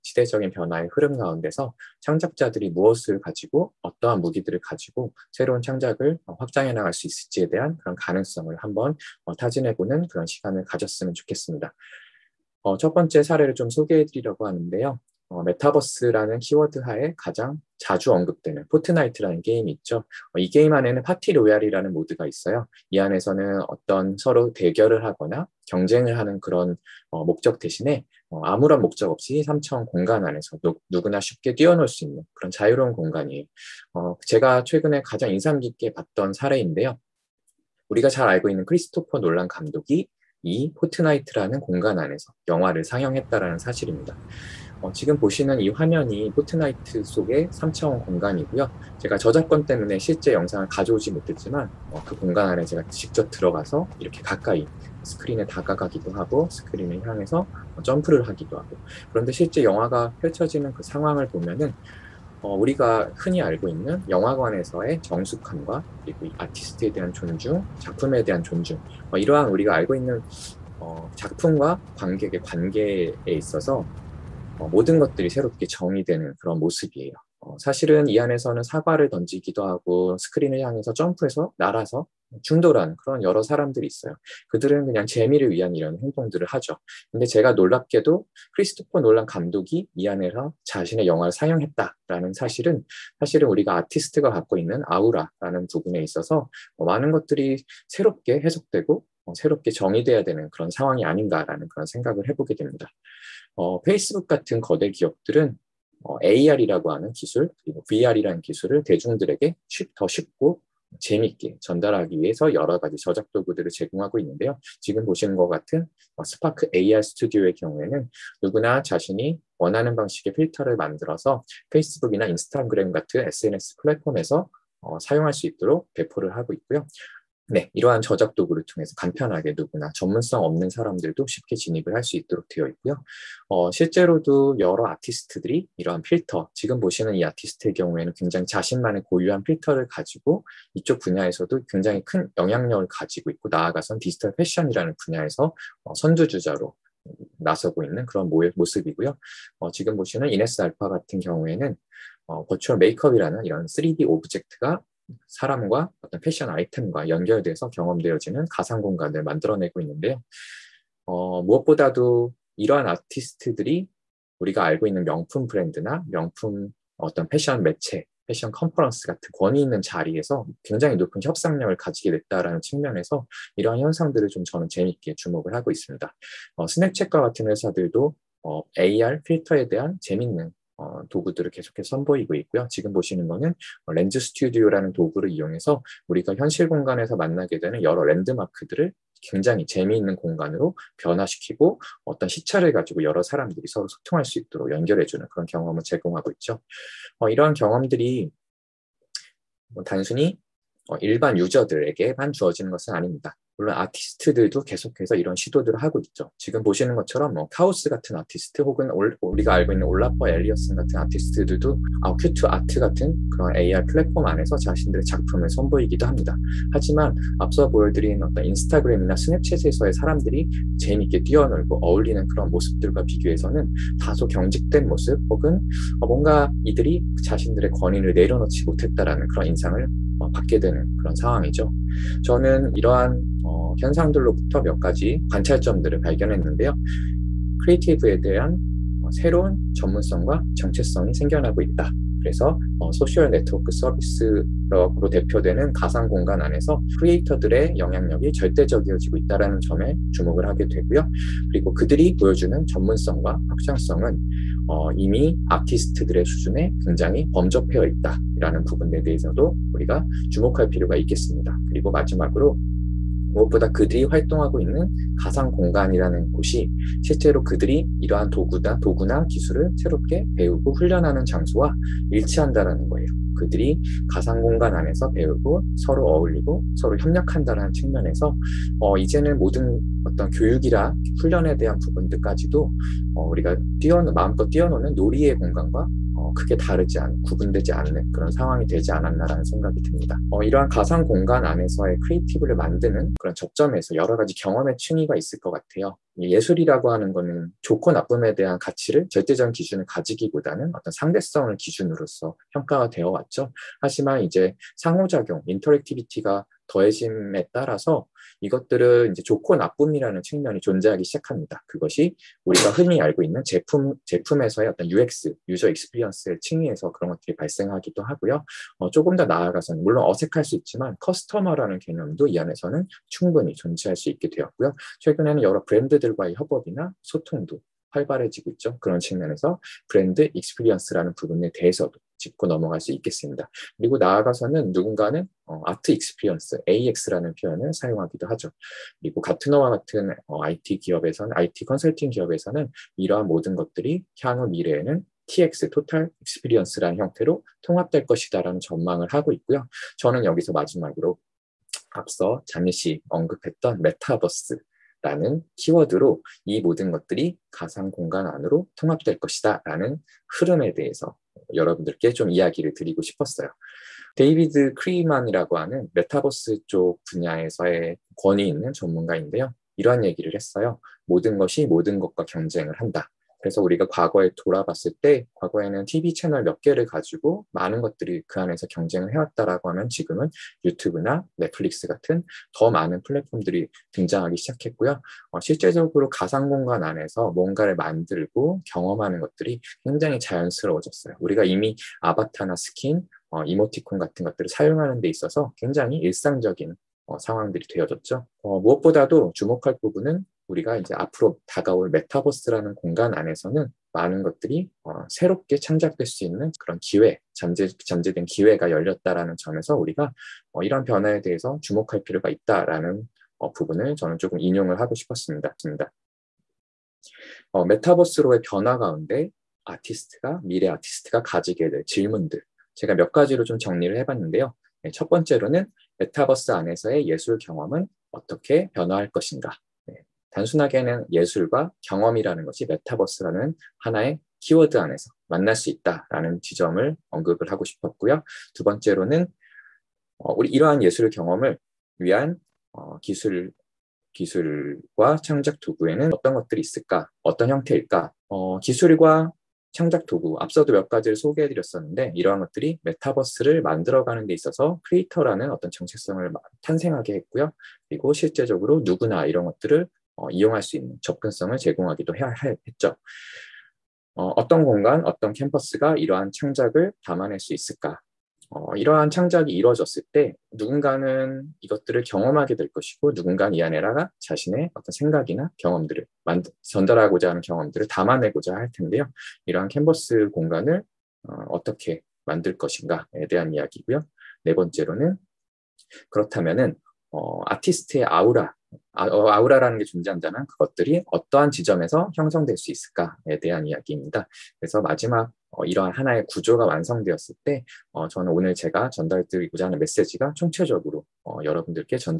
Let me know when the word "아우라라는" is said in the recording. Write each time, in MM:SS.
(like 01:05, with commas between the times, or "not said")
01:34, 08:09.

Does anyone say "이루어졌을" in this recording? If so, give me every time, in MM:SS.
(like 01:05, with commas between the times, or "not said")
07:49.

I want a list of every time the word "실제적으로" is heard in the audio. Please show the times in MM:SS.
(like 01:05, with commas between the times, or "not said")
06:25, 07:38.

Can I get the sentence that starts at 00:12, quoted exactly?
어, 첫 번째 사례를 좀 소개해드리려고 하는데요.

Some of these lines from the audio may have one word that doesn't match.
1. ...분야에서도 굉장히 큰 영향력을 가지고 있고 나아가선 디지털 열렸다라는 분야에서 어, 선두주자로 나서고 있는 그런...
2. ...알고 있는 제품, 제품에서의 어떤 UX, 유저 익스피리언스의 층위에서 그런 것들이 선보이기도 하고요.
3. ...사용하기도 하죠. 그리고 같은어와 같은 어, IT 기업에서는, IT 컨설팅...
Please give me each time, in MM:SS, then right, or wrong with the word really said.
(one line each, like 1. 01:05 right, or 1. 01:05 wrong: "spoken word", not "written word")
1. 02:20 wrong: "패션이라는", not "열렸다라는"
2. 05:13 wrong: "발생하기도", not "선보이기도"
3. 05:37 right.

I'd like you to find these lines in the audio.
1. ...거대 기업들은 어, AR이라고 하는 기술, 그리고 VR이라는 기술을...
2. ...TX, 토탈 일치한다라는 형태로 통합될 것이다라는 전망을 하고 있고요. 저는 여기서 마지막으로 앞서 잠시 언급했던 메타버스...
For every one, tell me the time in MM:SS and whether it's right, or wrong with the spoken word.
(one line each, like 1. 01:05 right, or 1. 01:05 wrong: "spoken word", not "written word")
1. 01:44 right
2. 05:45 wrong: "익스피리언스라는", not "일치한다라는".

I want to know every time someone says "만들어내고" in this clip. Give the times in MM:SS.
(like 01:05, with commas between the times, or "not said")
02:39.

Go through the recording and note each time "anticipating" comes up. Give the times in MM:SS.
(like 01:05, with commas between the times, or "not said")
not said.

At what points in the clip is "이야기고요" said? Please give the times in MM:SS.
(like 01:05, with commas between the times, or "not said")
08:03.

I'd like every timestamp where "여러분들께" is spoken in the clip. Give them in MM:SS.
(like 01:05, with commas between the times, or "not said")
06:01, 08:21.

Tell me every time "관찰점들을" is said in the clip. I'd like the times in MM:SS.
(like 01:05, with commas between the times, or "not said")
03:55.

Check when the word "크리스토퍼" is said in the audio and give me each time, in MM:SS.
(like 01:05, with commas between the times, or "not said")
00:38, 01:28.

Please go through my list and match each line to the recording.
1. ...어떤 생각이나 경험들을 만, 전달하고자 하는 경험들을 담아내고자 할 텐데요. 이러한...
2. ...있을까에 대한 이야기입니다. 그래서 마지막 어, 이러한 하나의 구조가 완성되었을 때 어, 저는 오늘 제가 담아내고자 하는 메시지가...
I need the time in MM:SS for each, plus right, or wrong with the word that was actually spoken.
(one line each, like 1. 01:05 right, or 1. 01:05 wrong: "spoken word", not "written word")
1. 07:54 right
2. 08:12 wrong: "전달드리고자", not "담아내고자".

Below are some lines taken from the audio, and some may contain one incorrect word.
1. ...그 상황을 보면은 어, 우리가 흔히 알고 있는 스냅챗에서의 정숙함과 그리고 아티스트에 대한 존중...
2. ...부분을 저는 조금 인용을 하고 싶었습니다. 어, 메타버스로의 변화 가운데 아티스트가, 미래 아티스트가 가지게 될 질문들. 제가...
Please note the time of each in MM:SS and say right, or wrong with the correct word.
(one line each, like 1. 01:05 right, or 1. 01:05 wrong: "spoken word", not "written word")
1. 01:00 wrong: "영화관에서의", not "스냅챗에서의"
2. 06:53 right.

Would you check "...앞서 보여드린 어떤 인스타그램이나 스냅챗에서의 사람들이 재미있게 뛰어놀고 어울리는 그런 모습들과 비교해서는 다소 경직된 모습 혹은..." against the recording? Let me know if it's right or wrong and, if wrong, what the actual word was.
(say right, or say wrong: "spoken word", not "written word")
right.